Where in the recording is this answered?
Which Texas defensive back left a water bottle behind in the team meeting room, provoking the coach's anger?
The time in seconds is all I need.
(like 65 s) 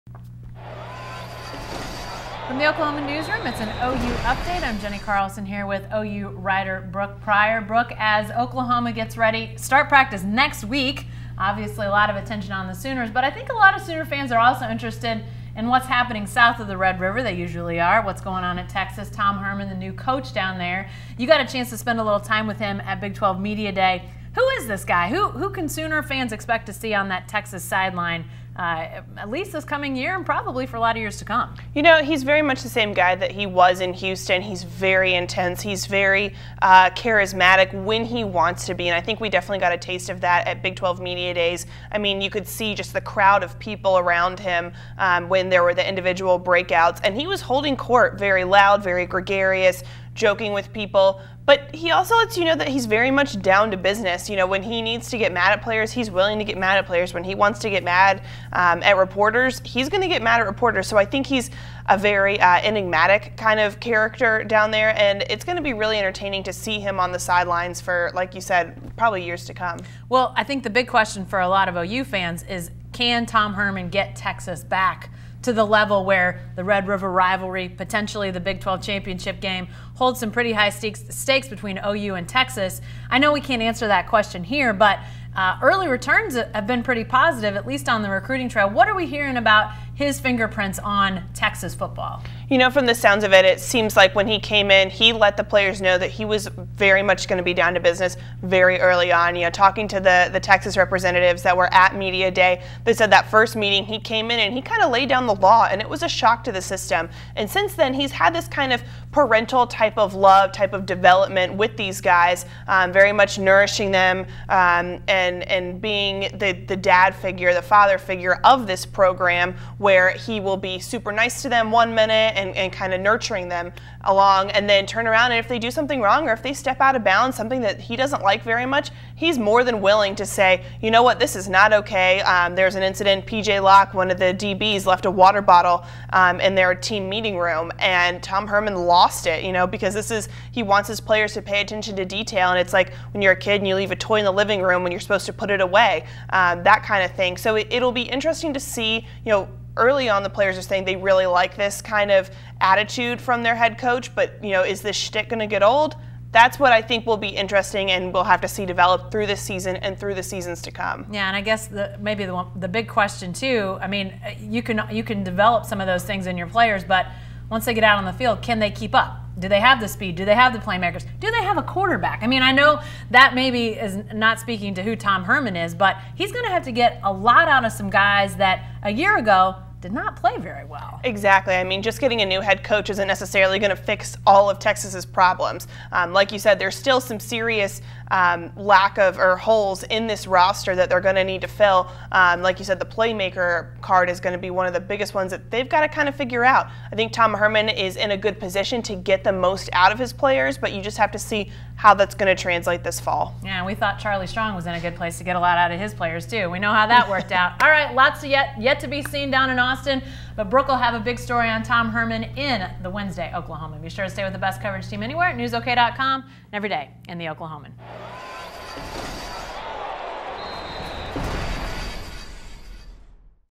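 133 s.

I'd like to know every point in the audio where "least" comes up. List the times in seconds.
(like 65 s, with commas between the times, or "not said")
29 s, 87 s.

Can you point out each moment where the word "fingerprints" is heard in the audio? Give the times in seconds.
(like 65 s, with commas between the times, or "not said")
90 s.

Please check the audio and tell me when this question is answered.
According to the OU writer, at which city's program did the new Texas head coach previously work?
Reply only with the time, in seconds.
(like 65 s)
33 s.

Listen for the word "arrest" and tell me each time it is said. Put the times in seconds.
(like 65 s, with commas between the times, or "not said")
not said.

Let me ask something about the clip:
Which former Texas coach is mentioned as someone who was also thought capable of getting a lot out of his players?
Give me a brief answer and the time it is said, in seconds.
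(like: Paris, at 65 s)
Charlie Strong, at 203 s.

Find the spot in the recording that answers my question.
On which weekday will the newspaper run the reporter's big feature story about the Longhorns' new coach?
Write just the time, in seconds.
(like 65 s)
212 s.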